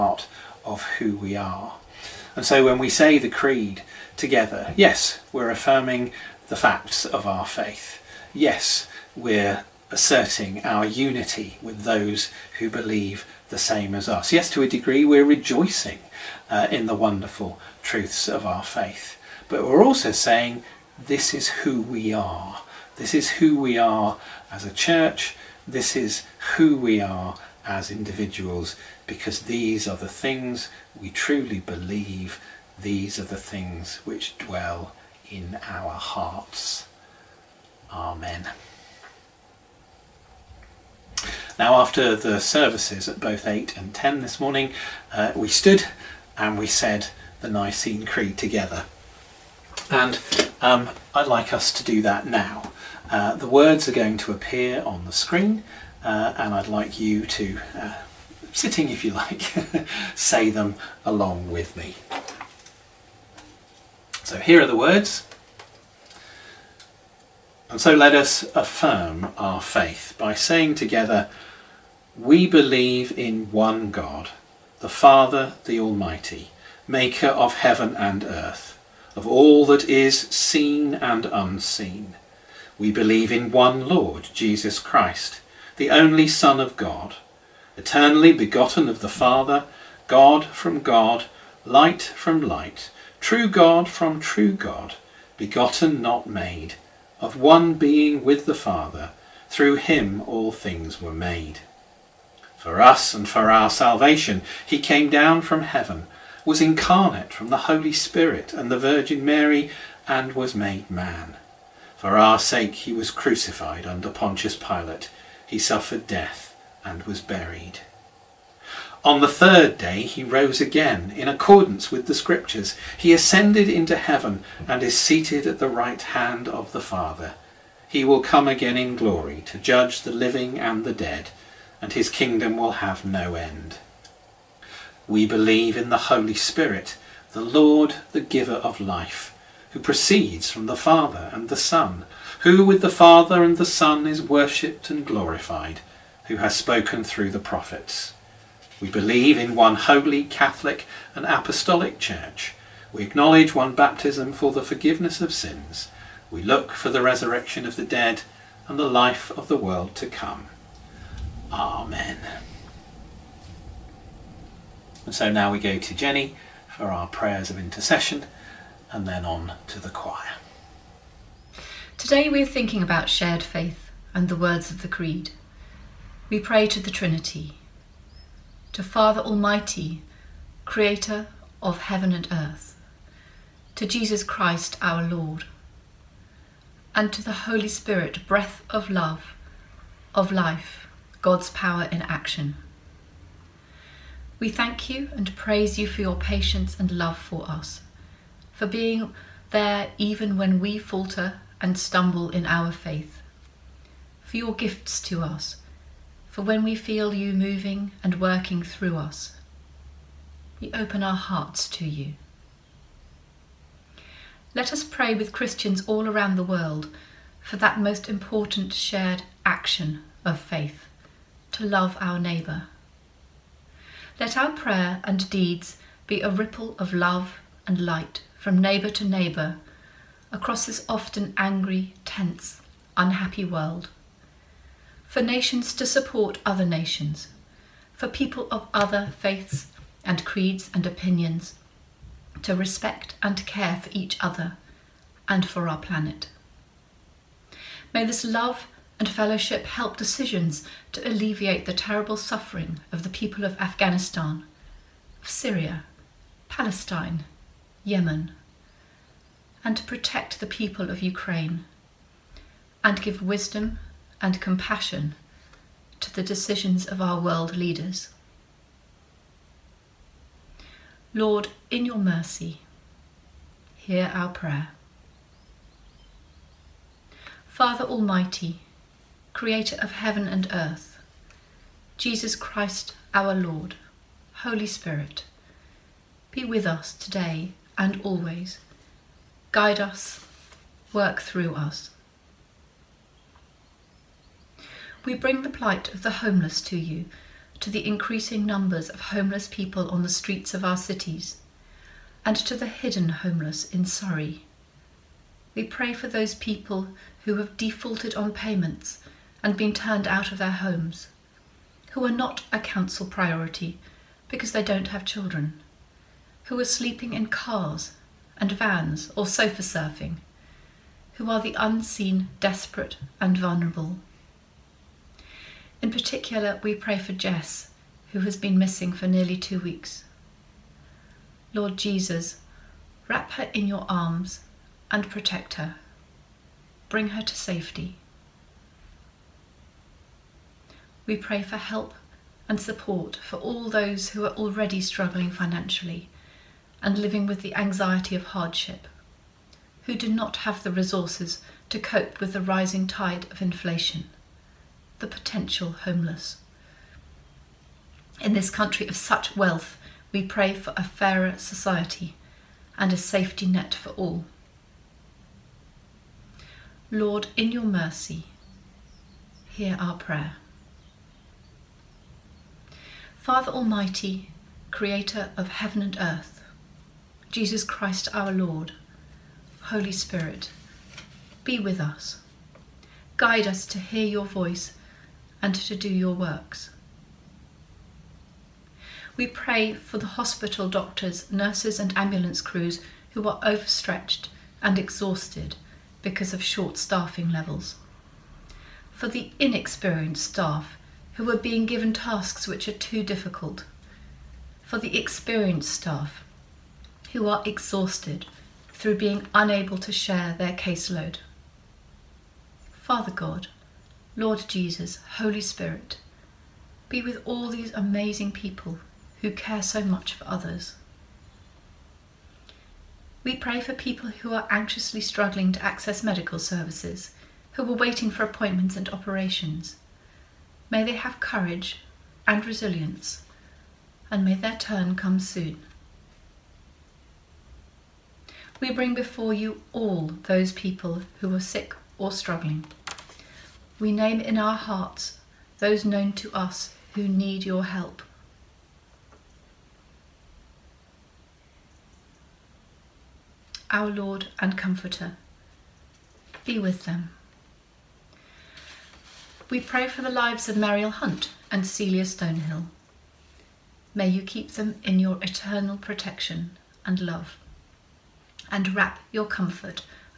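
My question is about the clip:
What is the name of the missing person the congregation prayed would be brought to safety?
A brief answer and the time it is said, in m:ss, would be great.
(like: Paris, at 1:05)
Jess, at 5:27.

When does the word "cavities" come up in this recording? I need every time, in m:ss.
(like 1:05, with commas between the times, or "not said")
not said.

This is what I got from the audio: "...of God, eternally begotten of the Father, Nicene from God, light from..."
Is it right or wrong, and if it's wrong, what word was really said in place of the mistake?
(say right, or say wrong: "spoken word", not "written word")
wrong: "God", not "Nicene".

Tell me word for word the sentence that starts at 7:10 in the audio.
May they have courage and resilience, and may their turn come soon.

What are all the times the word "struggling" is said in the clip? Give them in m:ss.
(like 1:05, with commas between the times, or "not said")
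5:44, 7:04, 7:22.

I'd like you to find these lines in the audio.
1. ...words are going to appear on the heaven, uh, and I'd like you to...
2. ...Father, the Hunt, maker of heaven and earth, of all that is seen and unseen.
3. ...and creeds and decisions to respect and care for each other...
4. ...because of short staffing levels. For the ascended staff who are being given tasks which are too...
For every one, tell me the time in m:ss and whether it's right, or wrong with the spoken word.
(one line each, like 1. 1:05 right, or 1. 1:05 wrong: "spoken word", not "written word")
1. 0:53 wrong: "screen", not "heaven"
2. 1:14 wrong: "Almighty", not "Hunt"
3. 4:00 wrong: "opinions", not "decisions"
4. 6:35 wrong: "inexperienced", not "ascended".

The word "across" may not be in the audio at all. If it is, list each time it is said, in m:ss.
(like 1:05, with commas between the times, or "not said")
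3:50.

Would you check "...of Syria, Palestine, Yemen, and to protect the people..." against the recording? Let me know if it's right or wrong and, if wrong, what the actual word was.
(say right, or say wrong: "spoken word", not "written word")
right.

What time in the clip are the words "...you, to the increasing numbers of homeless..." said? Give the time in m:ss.
4:56.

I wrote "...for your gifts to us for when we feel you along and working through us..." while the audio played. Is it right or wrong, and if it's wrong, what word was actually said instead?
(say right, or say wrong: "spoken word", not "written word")
wrong: "moving", not "along".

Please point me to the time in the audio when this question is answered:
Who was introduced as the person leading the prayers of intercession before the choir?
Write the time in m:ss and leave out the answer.
2:45.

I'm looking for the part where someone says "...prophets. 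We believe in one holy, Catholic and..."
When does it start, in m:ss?
2:27.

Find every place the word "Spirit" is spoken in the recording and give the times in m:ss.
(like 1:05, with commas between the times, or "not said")
1:47, 2:16, 3:07, 4:44, 6:19, 6:55.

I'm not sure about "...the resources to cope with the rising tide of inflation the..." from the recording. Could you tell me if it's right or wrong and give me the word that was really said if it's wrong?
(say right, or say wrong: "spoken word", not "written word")
right.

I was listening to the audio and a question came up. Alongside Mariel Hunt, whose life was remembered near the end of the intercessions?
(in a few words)
Celia Stonehill.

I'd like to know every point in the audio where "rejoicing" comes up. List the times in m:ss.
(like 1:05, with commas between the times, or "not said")
0:15.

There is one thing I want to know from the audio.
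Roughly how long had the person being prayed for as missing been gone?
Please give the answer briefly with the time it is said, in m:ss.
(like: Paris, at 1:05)
2 weeks, at 5:29.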